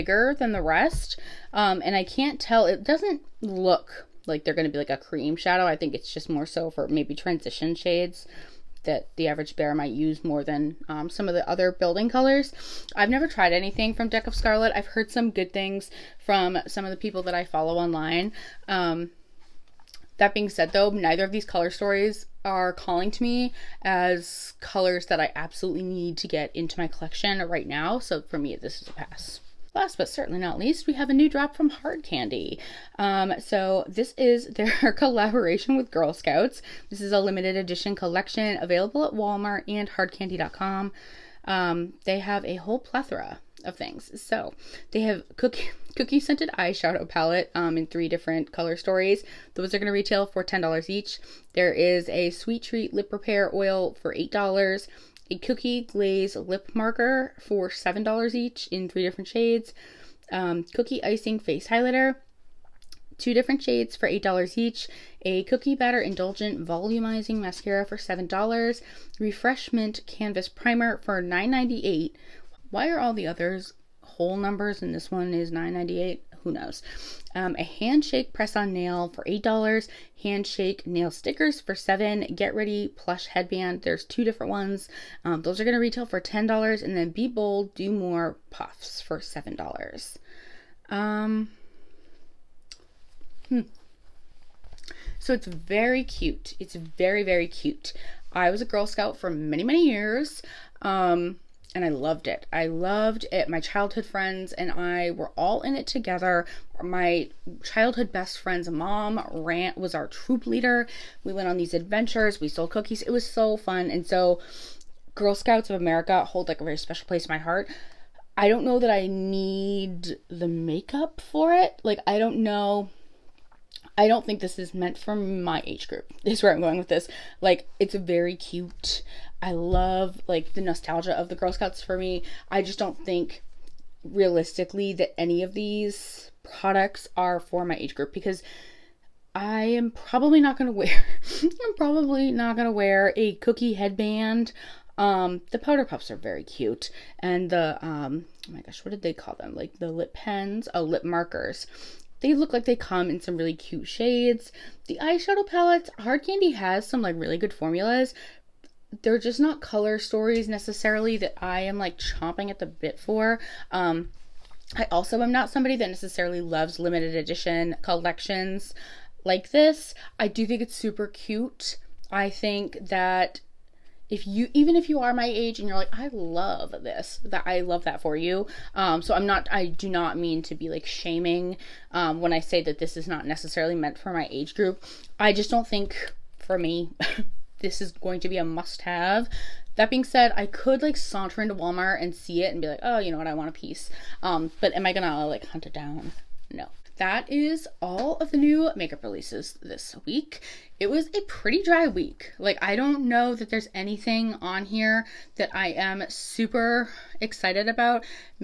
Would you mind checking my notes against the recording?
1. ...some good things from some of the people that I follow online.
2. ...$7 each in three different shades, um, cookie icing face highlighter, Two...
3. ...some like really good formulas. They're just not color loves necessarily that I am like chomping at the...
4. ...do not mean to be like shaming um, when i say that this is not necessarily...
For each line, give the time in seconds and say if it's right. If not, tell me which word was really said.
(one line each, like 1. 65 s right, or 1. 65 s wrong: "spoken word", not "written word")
1. 15 s right
2. 57 s right
3. 156 s wrong: "stories", not "loves"
4. 179 s right.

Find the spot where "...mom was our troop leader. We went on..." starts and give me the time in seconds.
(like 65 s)
108 s.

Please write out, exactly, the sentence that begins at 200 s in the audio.
It was a pretty dry week.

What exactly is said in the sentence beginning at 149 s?
Like the lip pens, oh, lip markers.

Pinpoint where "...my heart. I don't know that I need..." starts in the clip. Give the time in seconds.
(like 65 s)
117 s.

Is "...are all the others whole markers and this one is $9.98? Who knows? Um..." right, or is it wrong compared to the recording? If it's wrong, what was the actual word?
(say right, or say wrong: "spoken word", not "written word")
wrong: "numbers", not "markers".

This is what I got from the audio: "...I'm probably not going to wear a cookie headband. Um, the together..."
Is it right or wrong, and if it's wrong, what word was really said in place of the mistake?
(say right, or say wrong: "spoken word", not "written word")
wrong: "powder", not "together".